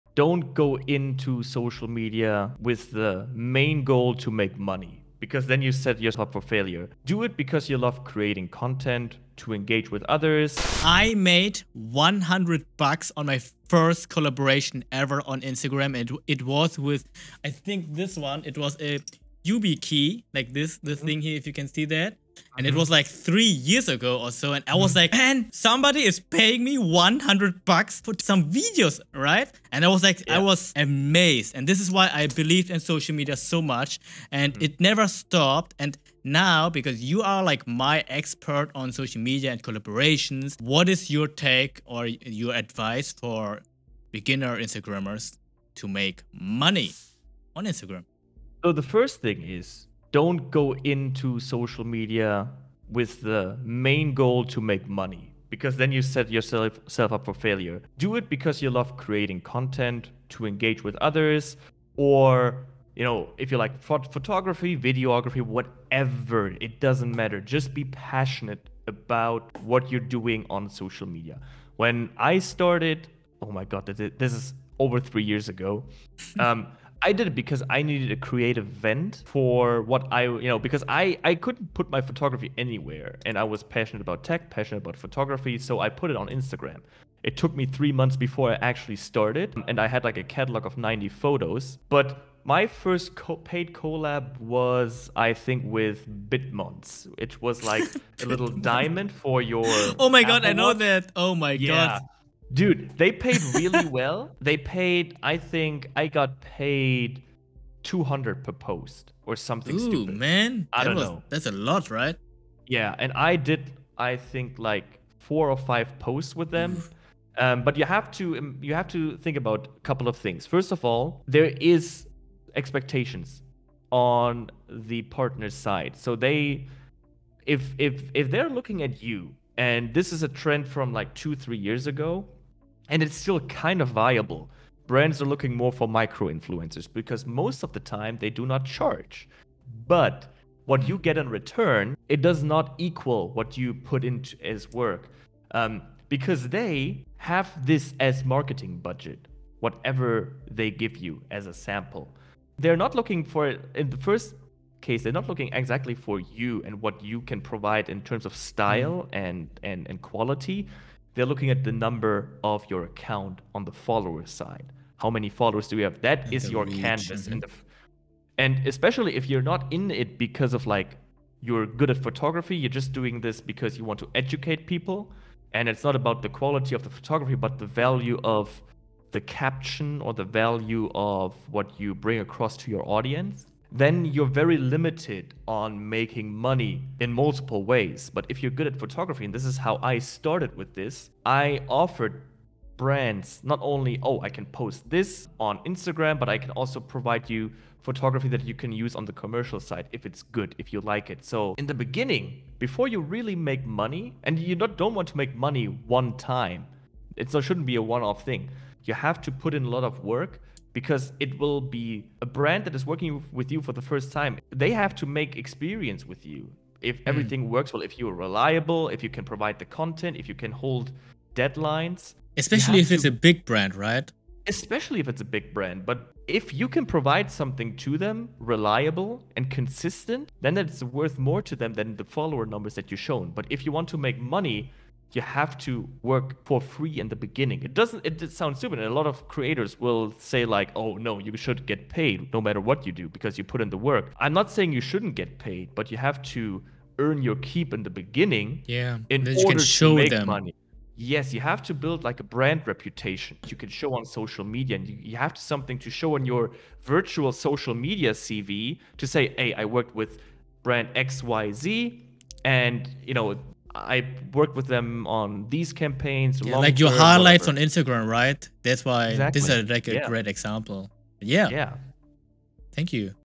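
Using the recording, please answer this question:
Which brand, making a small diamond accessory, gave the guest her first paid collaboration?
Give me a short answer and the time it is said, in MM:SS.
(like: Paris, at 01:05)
Bitmons, at 01:36.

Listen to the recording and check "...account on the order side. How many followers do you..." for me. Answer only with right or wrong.
wrong.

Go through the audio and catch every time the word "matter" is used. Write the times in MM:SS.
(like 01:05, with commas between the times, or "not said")
01:07, 04:02.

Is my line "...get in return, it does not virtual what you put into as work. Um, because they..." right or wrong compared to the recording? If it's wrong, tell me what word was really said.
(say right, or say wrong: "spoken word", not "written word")
wrong: "equal", not "virtual".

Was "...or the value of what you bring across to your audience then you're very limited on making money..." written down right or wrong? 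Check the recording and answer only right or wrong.
right.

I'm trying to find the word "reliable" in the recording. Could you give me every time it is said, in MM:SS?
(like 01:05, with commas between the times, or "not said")
03:38, 03:48.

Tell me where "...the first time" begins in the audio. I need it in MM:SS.
03:33.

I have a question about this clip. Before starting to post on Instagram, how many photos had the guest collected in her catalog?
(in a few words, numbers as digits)
90.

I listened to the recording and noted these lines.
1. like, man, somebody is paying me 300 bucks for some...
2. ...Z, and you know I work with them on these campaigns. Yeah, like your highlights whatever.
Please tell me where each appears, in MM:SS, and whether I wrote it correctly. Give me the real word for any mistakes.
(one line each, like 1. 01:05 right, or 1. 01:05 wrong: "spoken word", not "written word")
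1. 00:24 wrong: "100", not "300"
2. 04:21 right.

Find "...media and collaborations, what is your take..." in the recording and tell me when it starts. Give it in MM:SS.
00:39.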